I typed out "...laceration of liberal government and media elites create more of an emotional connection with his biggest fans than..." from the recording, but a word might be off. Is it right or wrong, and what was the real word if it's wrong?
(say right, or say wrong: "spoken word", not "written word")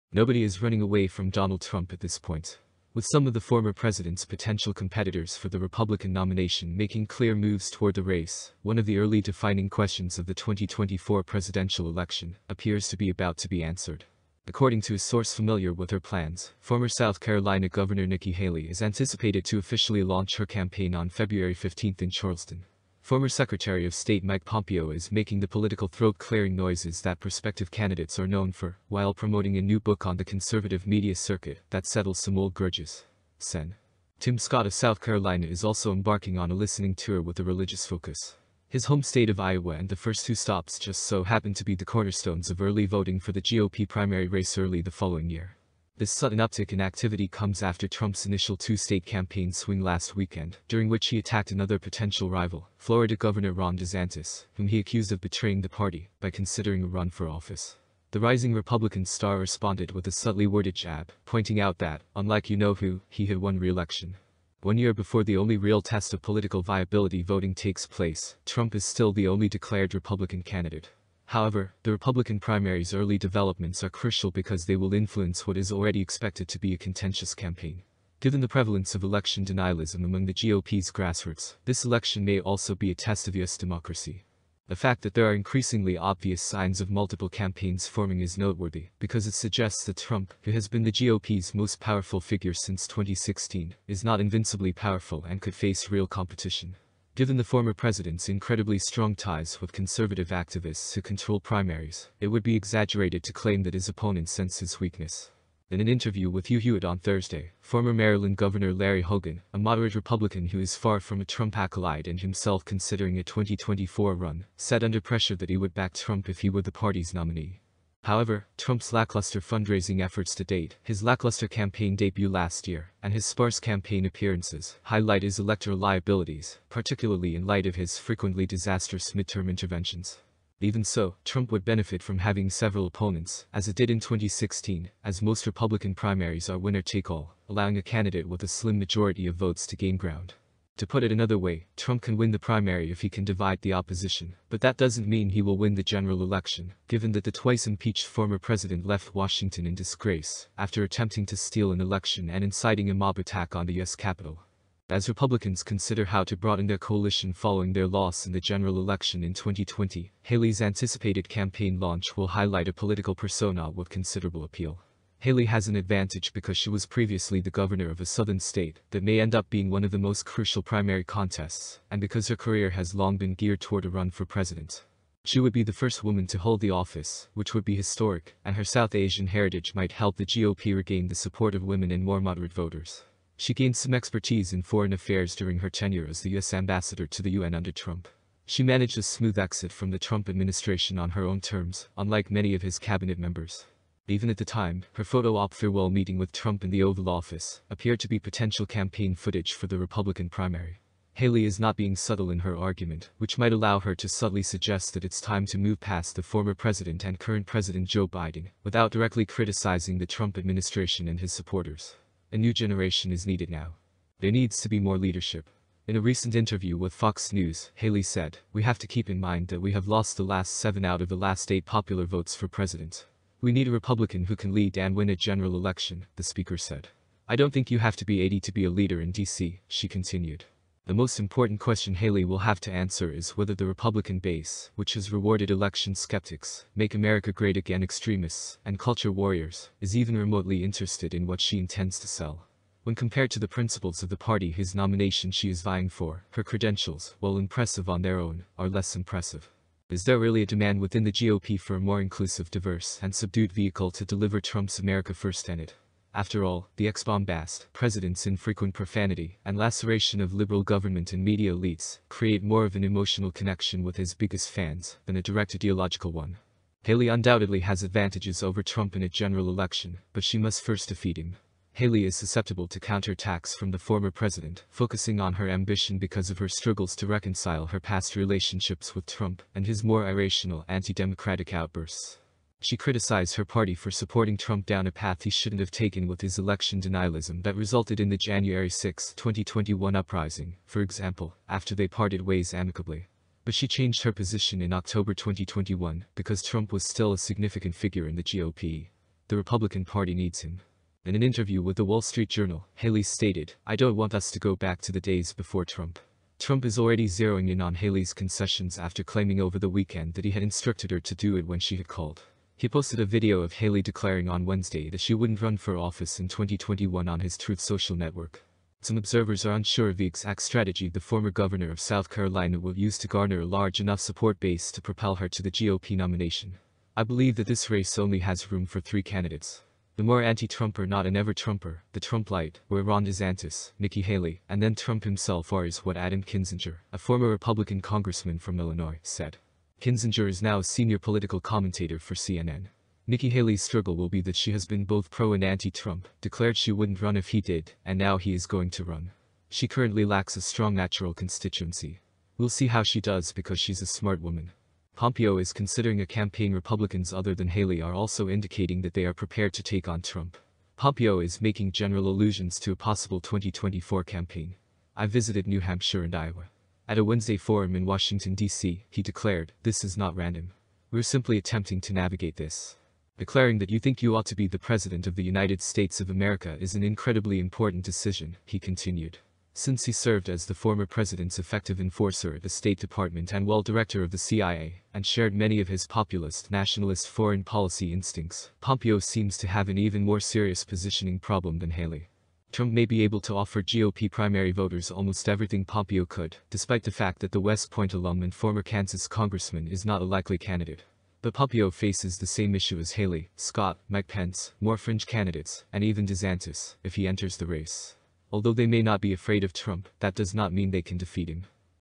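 right.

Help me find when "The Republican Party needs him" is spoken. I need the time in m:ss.
4:59.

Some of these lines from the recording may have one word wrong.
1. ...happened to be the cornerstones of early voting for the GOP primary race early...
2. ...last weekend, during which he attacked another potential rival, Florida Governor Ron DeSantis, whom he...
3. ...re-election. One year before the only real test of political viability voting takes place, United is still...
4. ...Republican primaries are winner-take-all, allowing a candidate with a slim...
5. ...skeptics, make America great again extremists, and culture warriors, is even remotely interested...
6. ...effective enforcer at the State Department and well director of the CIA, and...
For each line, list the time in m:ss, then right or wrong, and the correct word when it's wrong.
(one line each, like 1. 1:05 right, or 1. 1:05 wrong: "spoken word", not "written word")
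1. 0:41 right
2. 0:49 right
3. 1:03 wrong: "Trump", not "United"
4. 2:15 right
5. 3:55 right
6. 6:21 right.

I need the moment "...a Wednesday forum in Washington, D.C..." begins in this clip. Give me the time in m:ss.
6:06.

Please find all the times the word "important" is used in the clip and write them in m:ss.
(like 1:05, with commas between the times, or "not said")
3:51, 6:17.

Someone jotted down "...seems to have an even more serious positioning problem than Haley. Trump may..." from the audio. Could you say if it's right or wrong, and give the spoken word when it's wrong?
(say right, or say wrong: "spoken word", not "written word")
right.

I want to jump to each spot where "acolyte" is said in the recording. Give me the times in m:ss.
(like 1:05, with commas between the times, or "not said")
1:51.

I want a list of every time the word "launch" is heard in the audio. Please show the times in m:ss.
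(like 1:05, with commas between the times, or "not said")
0:20, 2:41.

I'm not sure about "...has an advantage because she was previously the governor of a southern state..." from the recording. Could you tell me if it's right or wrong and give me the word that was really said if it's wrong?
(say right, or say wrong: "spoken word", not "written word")
right.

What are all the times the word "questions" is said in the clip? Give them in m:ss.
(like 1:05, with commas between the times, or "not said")
0:09, 3:51.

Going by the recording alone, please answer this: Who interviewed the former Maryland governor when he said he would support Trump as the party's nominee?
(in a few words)
Hugh Hewitt.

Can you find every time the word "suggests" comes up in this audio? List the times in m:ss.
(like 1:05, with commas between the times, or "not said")
1:29, 3:24.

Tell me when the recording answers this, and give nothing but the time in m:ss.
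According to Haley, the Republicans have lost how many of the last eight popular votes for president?
3:40.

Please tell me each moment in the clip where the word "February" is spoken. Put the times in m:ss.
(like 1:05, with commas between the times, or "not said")
0:21.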